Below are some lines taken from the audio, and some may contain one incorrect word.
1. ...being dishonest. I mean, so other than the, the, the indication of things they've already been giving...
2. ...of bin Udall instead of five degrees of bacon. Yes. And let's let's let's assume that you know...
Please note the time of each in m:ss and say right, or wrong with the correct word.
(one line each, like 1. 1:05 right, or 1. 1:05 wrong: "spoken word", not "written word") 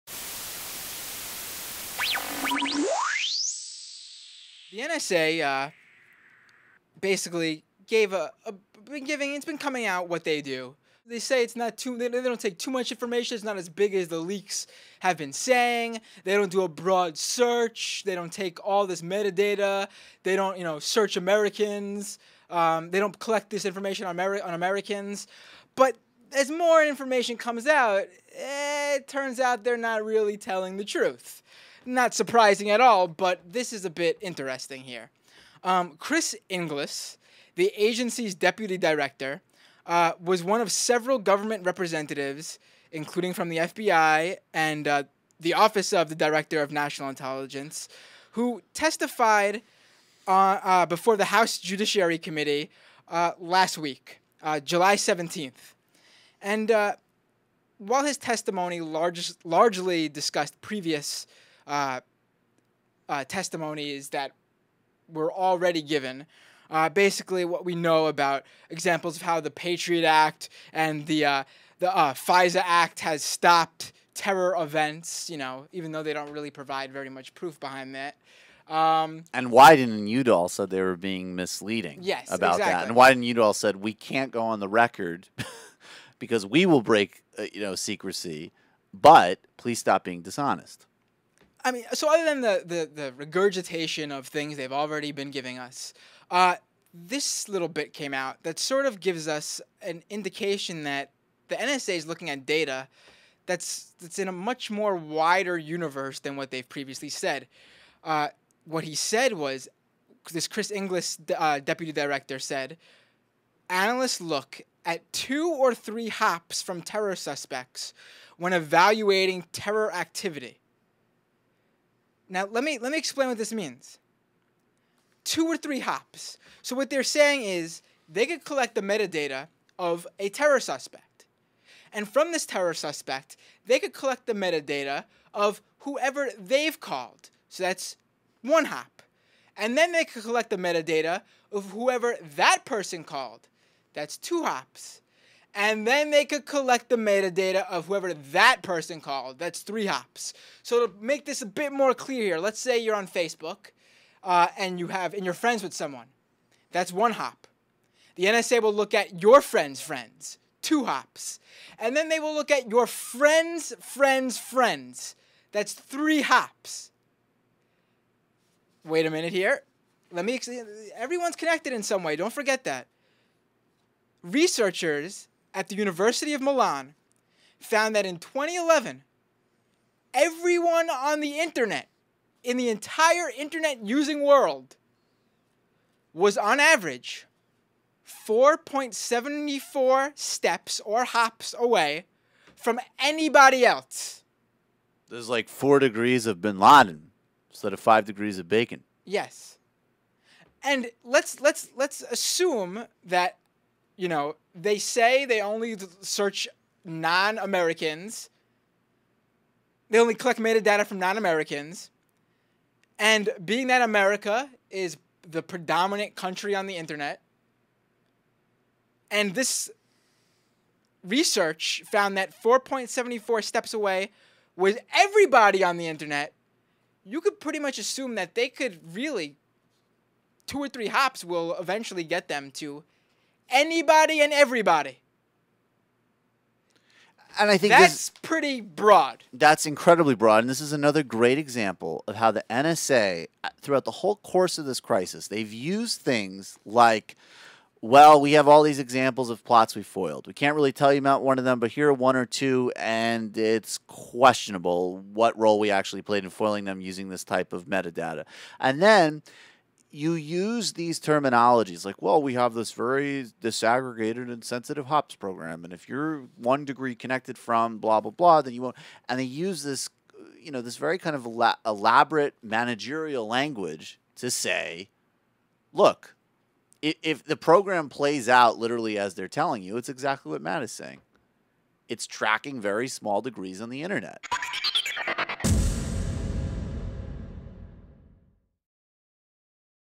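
1. 1:30 wrong: "regurgitation", not "indication"
2. 3:16 wrong: "Laden", not "Udall".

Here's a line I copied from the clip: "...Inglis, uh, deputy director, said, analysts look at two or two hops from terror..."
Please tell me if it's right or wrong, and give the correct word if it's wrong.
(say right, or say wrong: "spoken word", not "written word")
wrong: "three", not "two".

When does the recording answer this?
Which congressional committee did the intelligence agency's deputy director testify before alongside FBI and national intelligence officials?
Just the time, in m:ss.
0:51.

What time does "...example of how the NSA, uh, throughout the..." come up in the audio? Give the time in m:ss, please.
4:01.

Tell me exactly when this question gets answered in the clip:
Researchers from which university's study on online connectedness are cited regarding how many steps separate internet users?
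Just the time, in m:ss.
2:55.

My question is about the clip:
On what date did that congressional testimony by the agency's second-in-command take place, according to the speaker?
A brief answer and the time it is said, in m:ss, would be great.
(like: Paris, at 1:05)
July 17th, at 0:54.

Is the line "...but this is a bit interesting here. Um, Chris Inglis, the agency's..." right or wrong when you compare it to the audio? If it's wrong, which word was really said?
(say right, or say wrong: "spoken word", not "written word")
right.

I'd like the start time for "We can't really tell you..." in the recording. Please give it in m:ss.
4:10.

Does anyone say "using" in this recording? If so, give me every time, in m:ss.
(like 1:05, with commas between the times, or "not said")
3:03, 4:16.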